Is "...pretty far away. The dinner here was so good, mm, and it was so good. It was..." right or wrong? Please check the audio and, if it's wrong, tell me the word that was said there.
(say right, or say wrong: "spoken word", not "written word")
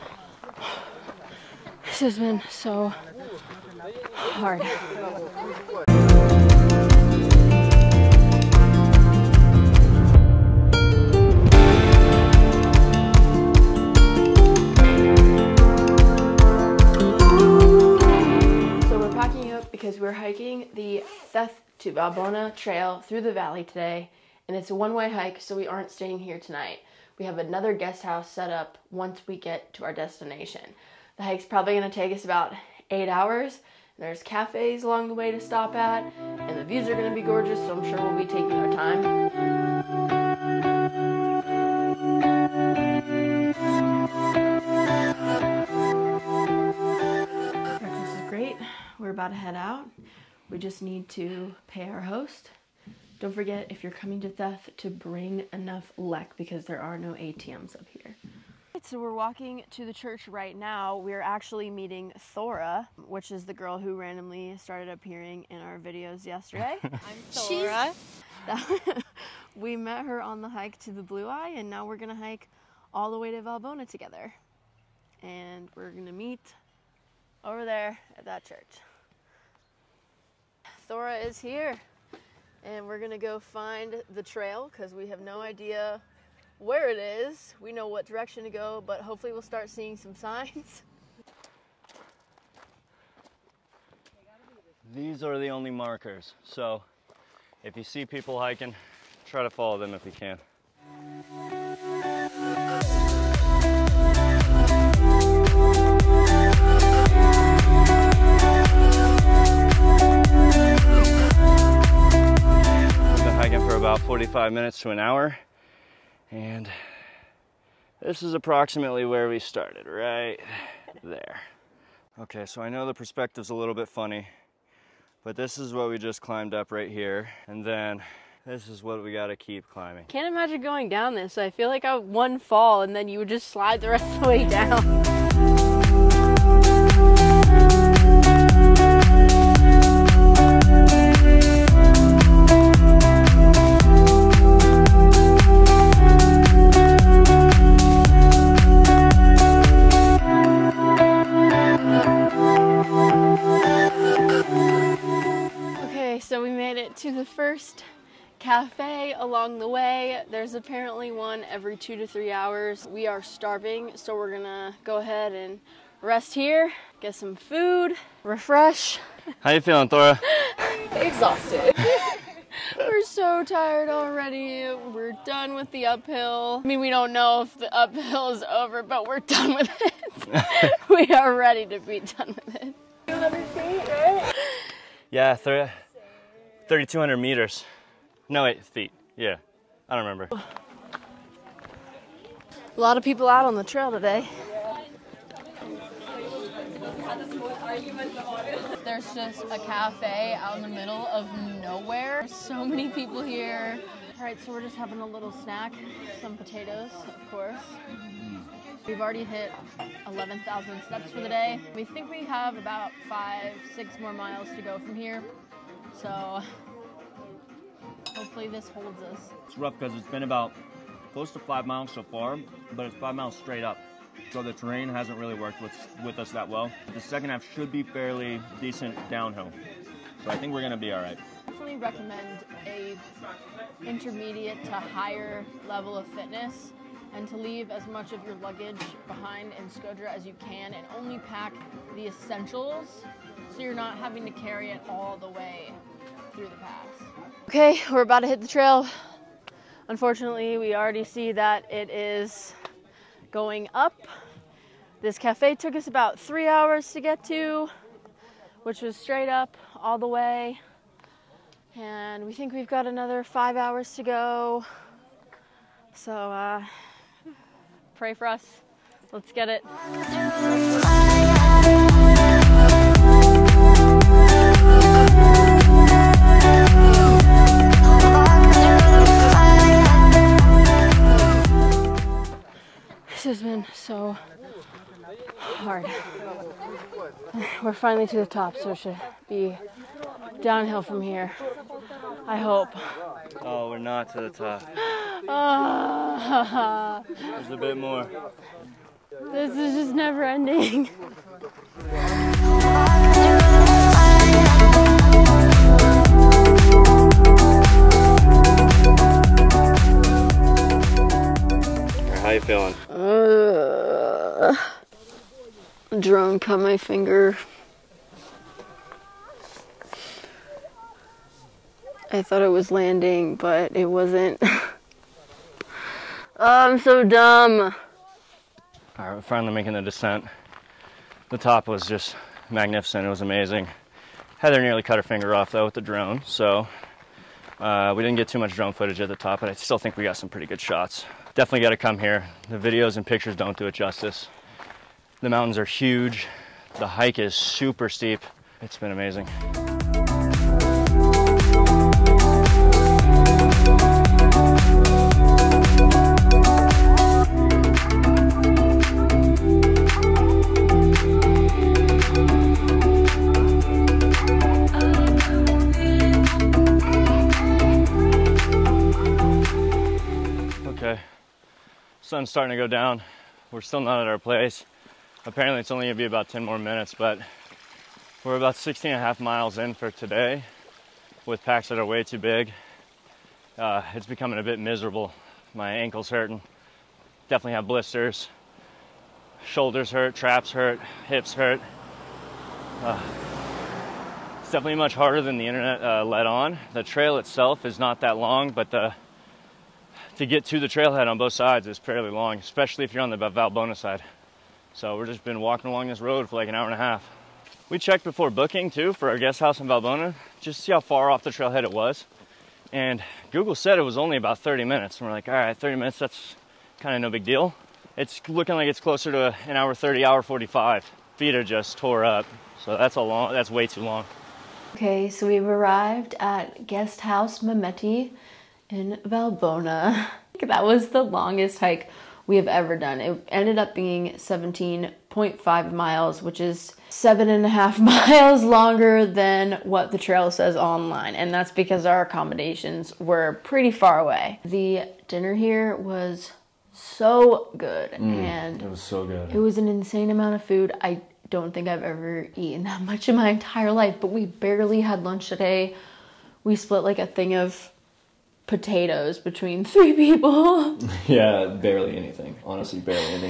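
right.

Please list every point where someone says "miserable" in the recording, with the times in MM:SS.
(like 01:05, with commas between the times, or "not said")
06:24.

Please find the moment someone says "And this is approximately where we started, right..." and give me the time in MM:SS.
01:56.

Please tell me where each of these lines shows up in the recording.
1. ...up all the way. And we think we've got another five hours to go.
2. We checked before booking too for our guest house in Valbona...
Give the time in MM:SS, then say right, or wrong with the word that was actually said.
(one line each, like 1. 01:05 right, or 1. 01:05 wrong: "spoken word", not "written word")
1. 04:19 right
2. 06:47 right.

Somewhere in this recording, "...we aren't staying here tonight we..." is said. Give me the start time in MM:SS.
00:25.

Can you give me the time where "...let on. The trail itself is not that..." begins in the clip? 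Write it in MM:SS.
06:36.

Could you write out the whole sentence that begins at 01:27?
We know what direction to go, but hopefully we'll start seeing some signs.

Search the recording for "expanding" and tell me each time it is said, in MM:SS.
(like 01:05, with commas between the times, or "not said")
not said.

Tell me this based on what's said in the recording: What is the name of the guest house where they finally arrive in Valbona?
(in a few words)
Mehmeti.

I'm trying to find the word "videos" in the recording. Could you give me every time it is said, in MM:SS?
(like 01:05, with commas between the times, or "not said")
01:05, 05:42.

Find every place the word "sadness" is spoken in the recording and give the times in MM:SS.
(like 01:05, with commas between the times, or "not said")
not said.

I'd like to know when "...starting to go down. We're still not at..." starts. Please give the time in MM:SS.
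06:12.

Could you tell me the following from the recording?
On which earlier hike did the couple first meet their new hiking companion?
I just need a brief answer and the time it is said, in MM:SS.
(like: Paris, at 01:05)
the Blue Eye, at 01:10.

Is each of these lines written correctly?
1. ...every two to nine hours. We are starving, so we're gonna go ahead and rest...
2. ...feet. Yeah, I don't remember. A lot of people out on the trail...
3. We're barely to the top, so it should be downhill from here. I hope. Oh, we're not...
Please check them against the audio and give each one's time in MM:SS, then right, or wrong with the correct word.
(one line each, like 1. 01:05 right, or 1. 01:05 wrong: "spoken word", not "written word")
1. 02:41 wrong: "three", not "nine"
2. 03:08 right
3. 04:47 wrong: "finally", not "barely".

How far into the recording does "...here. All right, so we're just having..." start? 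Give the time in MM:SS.
03:23.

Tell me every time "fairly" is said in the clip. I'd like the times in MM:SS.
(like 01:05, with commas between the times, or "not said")
03:47, 06:41.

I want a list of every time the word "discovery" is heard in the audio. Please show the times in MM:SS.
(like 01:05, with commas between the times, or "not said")
not said.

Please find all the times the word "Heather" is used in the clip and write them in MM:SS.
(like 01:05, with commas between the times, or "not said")
05:34.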